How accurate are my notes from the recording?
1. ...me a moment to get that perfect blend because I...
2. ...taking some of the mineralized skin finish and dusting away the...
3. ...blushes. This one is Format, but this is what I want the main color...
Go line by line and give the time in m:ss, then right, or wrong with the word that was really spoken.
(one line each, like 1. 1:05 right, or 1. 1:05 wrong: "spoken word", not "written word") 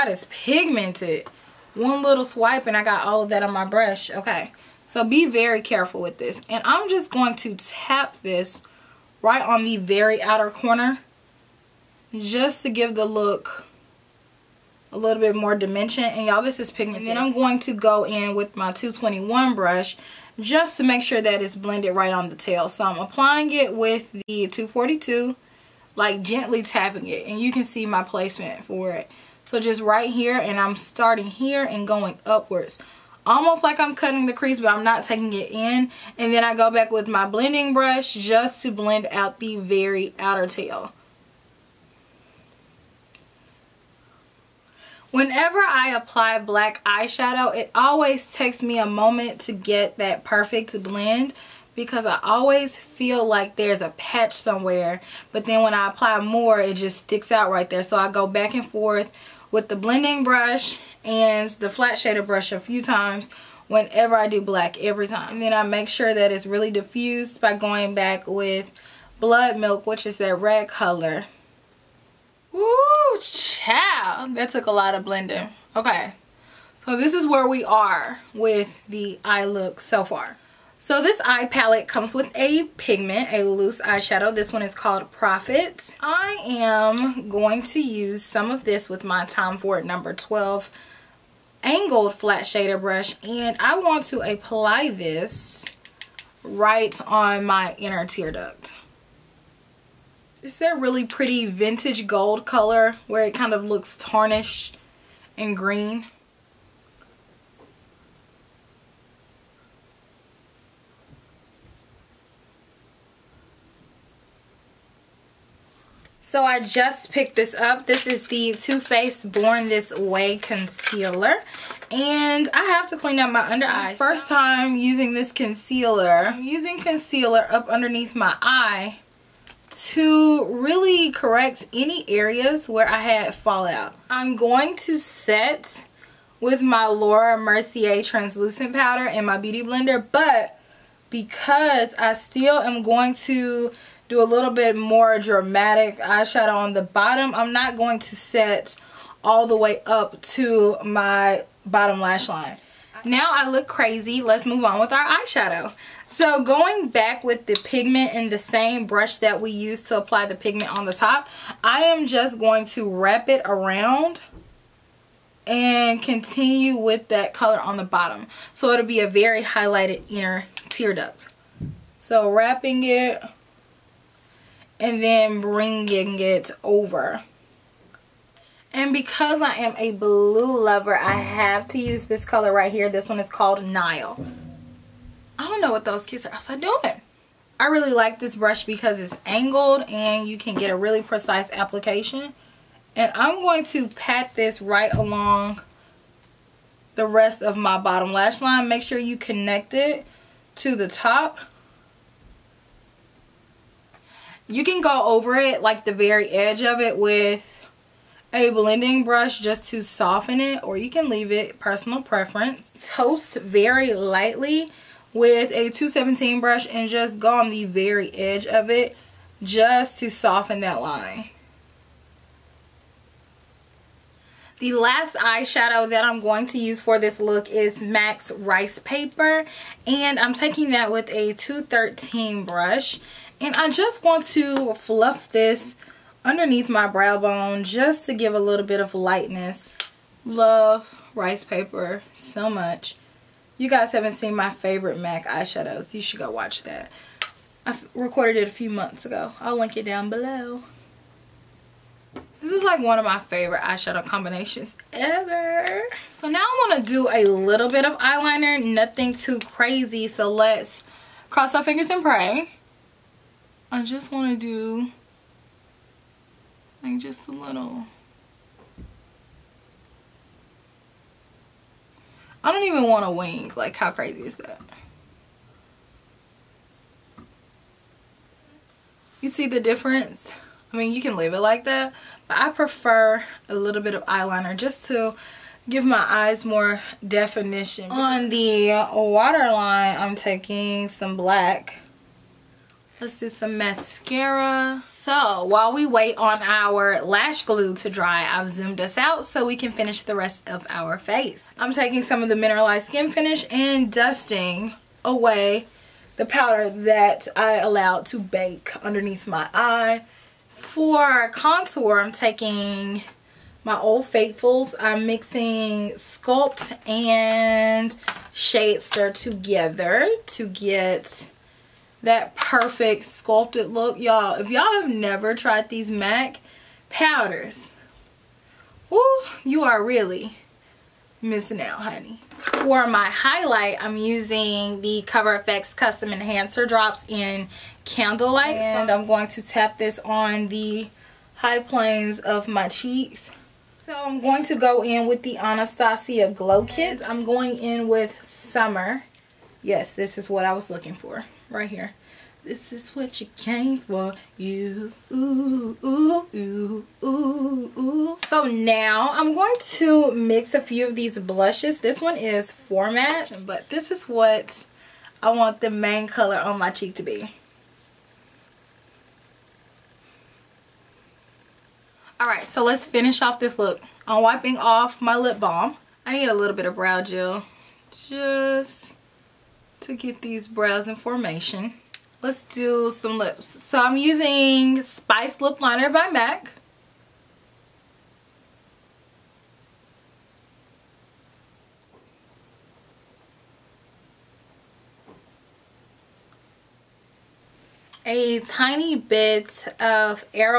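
1. 0:48 right
2. 5:01 right
3. 6:01 right.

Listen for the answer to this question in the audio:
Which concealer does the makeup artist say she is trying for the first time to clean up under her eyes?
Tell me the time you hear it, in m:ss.
1:58.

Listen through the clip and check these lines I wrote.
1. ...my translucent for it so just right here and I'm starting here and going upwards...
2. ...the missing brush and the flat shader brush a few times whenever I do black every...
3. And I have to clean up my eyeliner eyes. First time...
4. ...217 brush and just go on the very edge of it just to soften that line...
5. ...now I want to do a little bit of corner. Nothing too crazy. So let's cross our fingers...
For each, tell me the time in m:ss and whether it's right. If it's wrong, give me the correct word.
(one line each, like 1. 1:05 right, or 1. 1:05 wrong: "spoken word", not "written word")
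1. 0:27 wrong: "placement", not "translucent"
2. 0:59 wrong: "blending", not "missing"
3. 2:01 wrong: "under", not "eyeliner"
4. 3:35 right
5. 4:16 wrong: "eyeliner", not "corner".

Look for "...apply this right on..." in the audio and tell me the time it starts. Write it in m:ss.
1:34.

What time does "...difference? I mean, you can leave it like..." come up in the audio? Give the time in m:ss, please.
4:39.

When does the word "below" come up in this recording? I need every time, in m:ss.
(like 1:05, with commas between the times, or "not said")
4:10.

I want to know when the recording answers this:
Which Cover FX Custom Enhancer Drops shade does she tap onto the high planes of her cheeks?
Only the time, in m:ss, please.
5:37.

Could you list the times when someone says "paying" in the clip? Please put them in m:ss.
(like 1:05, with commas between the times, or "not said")
not said.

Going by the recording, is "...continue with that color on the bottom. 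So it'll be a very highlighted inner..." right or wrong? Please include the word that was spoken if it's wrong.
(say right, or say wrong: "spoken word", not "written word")
right.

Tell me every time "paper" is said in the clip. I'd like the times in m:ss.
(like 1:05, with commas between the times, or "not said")
3:48, 4:01.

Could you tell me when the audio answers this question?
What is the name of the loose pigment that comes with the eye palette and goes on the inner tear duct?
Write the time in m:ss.
1:25.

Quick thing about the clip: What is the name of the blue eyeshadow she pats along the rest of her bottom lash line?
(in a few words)
Nile.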